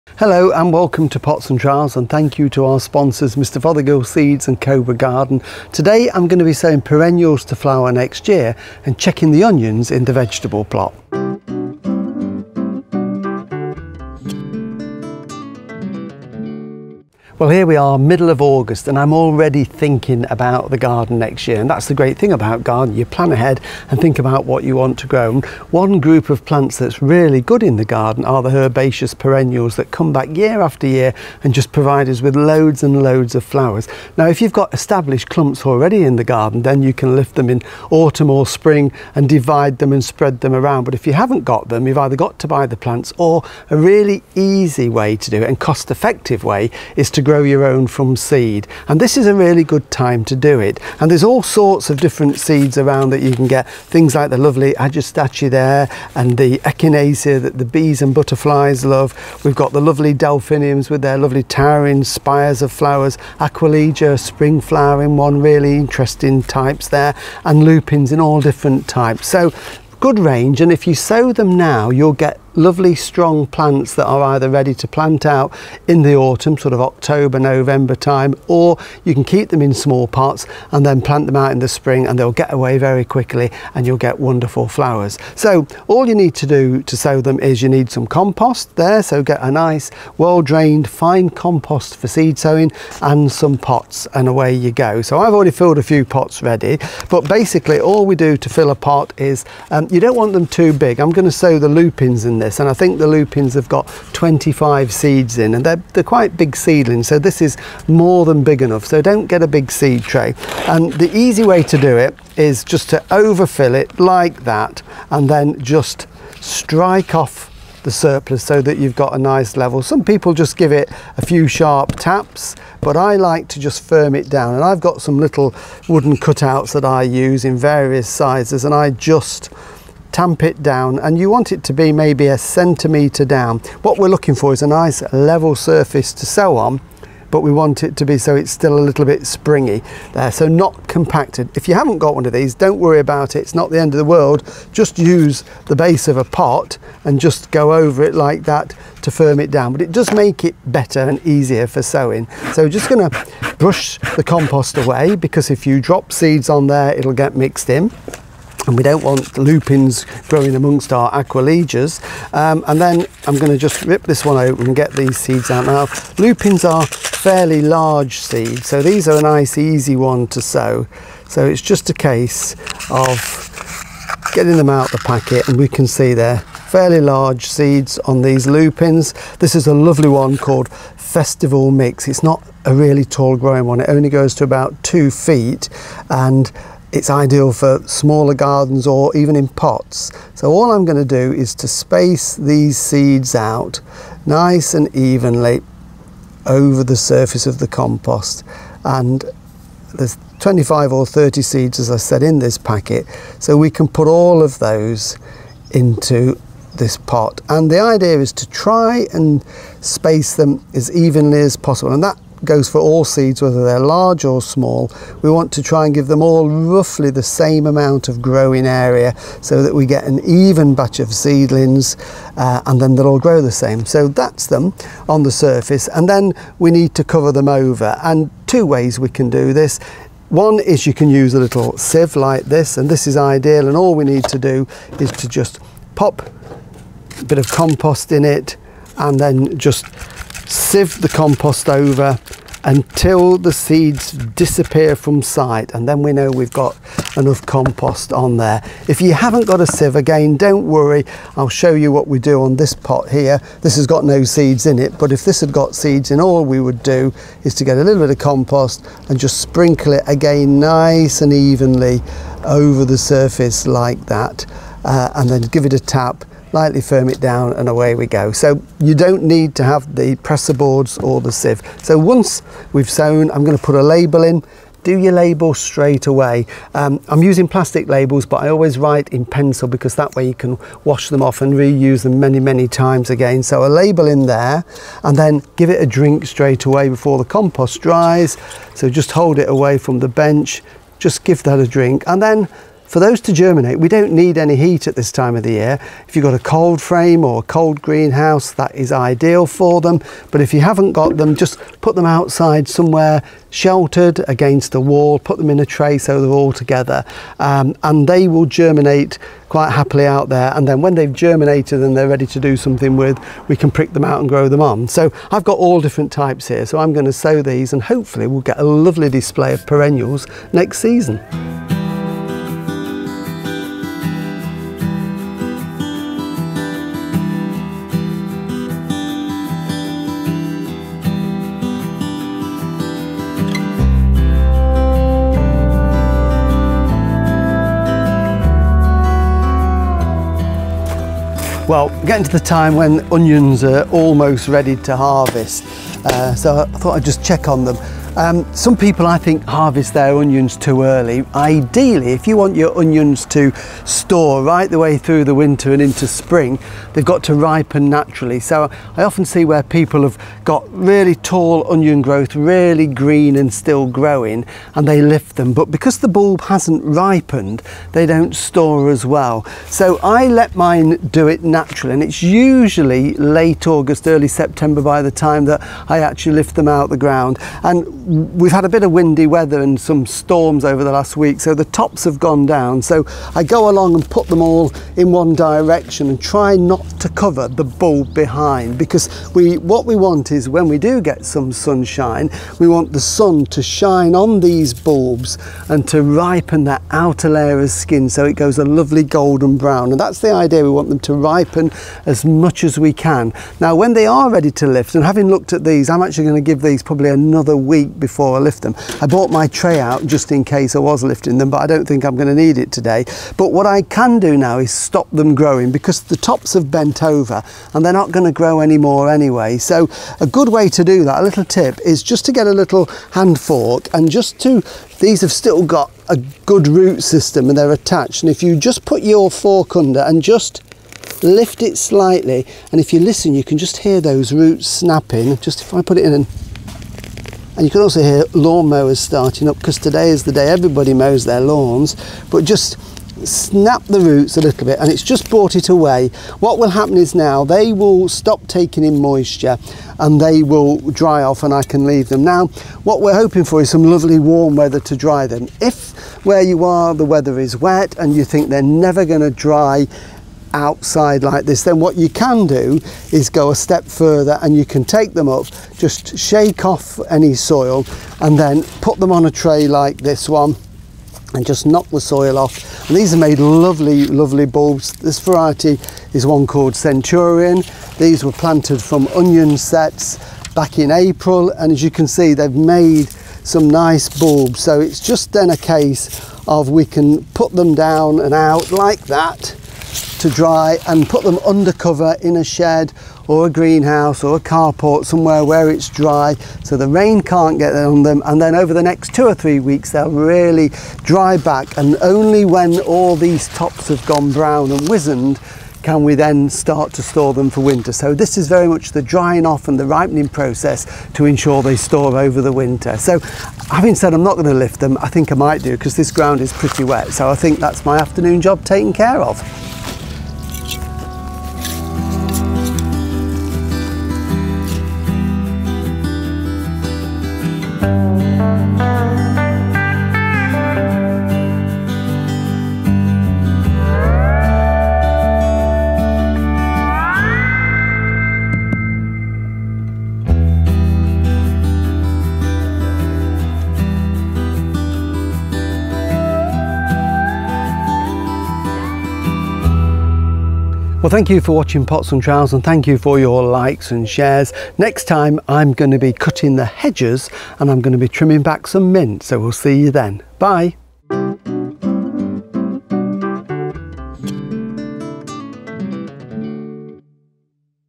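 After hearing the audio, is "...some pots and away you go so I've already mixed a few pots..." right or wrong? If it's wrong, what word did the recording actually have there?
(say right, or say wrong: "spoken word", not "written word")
wrong: "filled", not "mixed".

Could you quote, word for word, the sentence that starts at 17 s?
Well, here we are, middle of August, and I'm already thinking about the garden next year.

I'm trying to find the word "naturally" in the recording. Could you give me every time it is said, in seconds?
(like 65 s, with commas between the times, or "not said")
357 s, 371 s.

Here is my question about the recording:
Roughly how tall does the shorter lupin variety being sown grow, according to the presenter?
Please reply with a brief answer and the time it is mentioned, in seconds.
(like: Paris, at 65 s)
2 feet, at 184 s.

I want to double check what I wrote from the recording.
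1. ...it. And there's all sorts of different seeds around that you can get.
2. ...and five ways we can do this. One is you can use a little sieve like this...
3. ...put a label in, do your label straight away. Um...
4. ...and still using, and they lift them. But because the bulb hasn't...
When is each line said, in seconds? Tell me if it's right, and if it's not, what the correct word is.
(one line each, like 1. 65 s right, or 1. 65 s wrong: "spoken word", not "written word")
1. 50 s right
2. 228 s wrong: "two", not "five"
3. 273 s right
4. 363 s wrong: "growing", not "using".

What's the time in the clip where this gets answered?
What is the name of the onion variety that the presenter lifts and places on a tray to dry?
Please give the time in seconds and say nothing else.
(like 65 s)
476 s.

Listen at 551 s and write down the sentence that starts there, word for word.
Well, thank you for watching Pots and Trowels, and thank you for your likes and shares.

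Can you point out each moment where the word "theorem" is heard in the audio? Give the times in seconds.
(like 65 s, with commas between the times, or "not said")
not said.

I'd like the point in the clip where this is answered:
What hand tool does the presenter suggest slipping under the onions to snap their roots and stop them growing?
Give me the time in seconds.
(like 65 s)
423 s.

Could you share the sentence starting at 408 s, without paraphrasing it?
I bought my tray out just in case I was lifting them, but I don't think I'm going to need it today.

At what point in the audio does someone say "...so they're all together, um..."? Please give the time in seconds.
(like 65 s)
305 s.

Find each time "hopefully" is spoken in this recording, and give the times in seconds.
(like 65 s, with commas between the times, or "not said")
317 s.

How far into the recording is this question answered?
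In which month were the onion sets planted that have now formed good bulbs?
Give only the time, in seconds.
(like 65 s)
480 s.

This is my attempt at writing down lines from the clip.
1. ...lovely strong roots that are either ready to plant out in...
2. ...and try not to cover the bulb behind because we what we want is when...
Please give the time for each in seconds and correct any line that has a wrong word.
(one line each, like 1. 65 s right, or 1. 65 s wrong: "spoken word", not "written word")
1. 72 s wrong: "plants", not "roots"
2. 386 s right.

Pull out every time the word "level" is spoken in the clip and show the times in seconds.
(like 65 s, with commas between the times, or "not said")
119 s, 135 s.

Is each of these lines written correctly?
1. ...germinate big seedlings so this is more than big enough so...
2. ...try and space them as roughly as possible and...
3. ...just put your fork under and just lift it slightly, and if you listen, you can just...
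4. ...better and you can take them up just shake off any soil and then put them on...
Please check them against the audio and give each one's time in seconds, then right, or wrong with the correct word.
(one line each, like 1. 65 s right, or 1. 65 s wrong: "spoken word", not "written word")
1. 106 s wrong: "quite", not "germinate"
2. 208 s wrong: "evenly", not "roughly"
3. 428 s right
4. 463 s wrong: "further", not "better".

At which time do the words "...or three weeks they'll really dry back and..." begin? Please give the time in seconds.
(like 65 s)
499 s.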